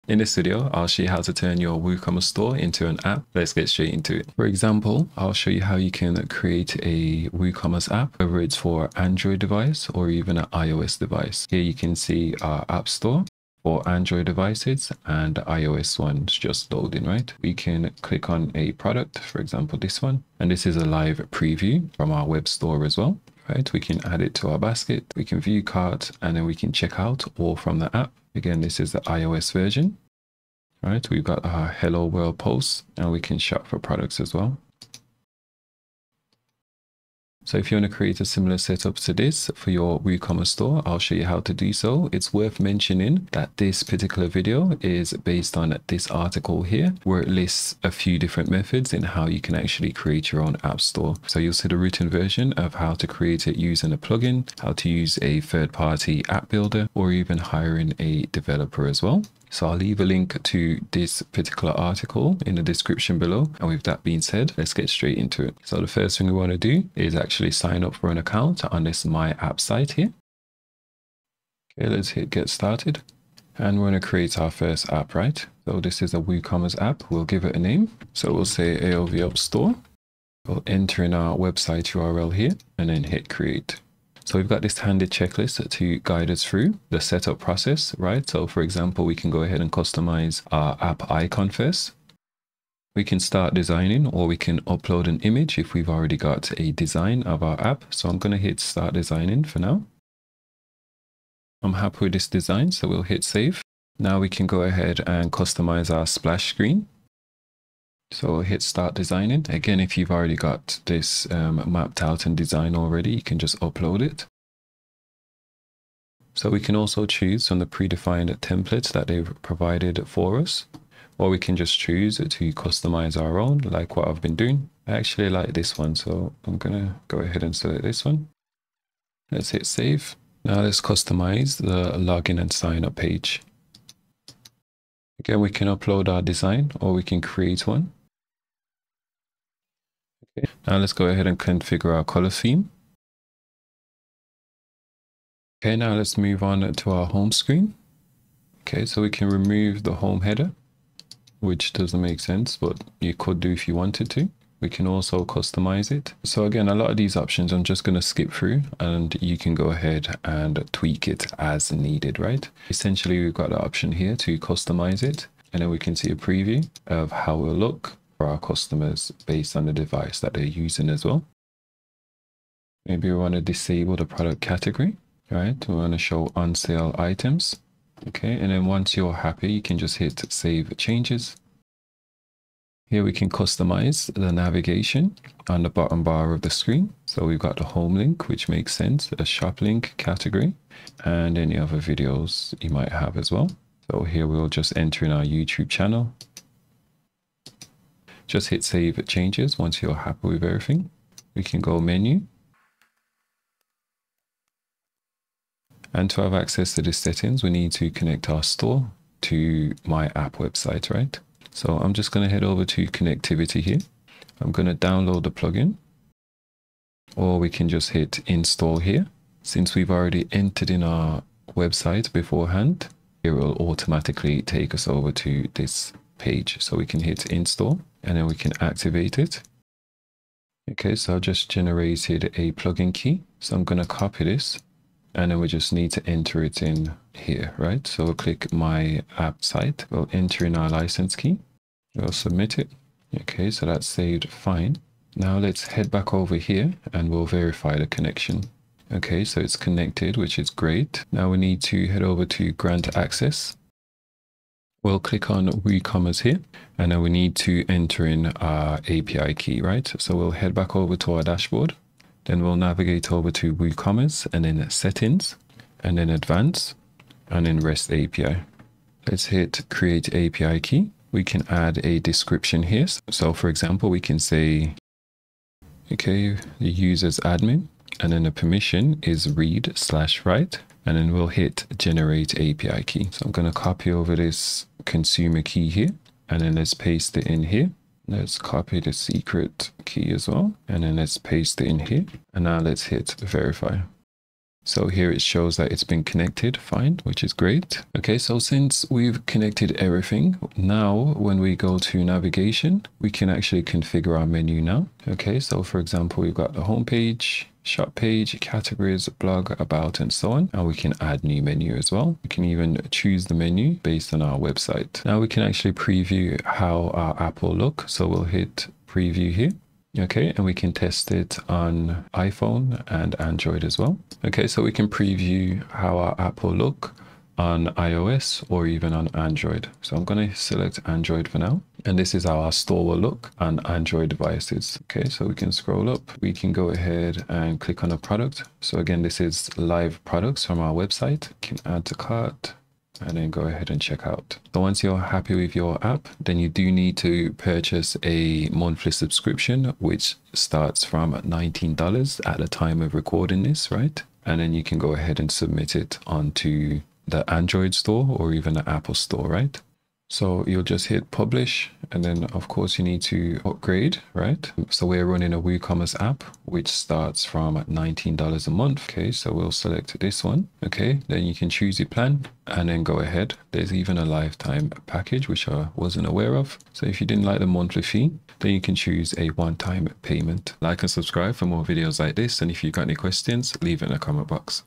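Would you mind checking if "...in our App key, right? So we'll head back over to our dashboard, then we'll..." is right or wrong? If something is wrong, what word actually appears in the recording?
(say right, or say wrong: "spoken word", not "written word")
wrong: "API", not "App".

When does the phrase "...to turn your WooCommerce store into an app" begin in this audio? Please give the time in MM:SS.
00:01.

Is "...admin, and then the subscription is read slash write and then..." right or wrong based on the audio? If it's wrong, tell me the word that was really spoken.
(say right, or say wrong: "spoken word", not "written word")
wrong: "permission", not "subscription".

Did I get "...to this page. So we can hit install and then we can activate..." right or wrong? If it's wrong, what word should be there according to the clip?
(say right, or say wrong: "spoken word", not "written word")
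right.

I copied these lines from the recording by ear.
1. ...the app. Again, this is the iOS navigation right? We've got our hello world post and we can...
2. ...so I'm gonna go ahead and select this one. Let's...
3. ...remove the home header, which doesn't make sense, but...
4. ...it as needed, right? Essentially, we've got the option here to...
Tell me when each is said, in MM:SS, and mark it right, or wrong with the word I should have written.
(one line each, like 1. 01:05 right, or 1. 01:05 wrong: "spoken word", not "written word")
1. 00:27 wrong: "version", not "navigation"
2. 02:05 right
3. 02:29 right
4. 02:41 right.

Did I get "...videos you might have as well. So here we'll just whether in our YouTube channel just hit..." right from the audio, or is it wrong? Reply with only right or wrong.
wrong.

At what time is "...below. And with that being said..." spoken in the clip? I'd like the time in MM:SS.
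01:03.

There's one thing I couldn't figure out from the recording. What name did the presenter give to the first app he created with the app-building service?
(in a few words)
ALV App Store.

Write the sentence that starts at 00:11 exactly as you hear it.
Here you can see our app store for Android devices and iOS one's just loading, right?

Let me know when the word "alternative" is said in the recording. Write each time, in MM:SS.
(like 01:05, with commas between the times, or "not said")
not said.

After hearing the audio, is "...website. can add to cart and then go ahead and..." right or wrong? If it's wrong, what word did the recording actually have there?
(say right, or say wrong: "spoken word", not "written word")
right.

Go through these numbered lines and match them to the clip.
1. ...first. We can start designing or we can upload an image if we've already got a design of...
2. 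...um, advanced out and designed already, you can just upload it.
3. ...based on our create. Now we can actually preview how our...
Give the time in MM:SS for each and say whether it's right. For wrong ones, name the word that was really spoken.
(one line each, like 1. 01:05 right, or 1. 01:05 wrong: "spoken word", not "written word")
1. 01:31 right
2. 01:51 wrong: "mapped", not "advanced"
3. 05:13 wrong: "website", not "create".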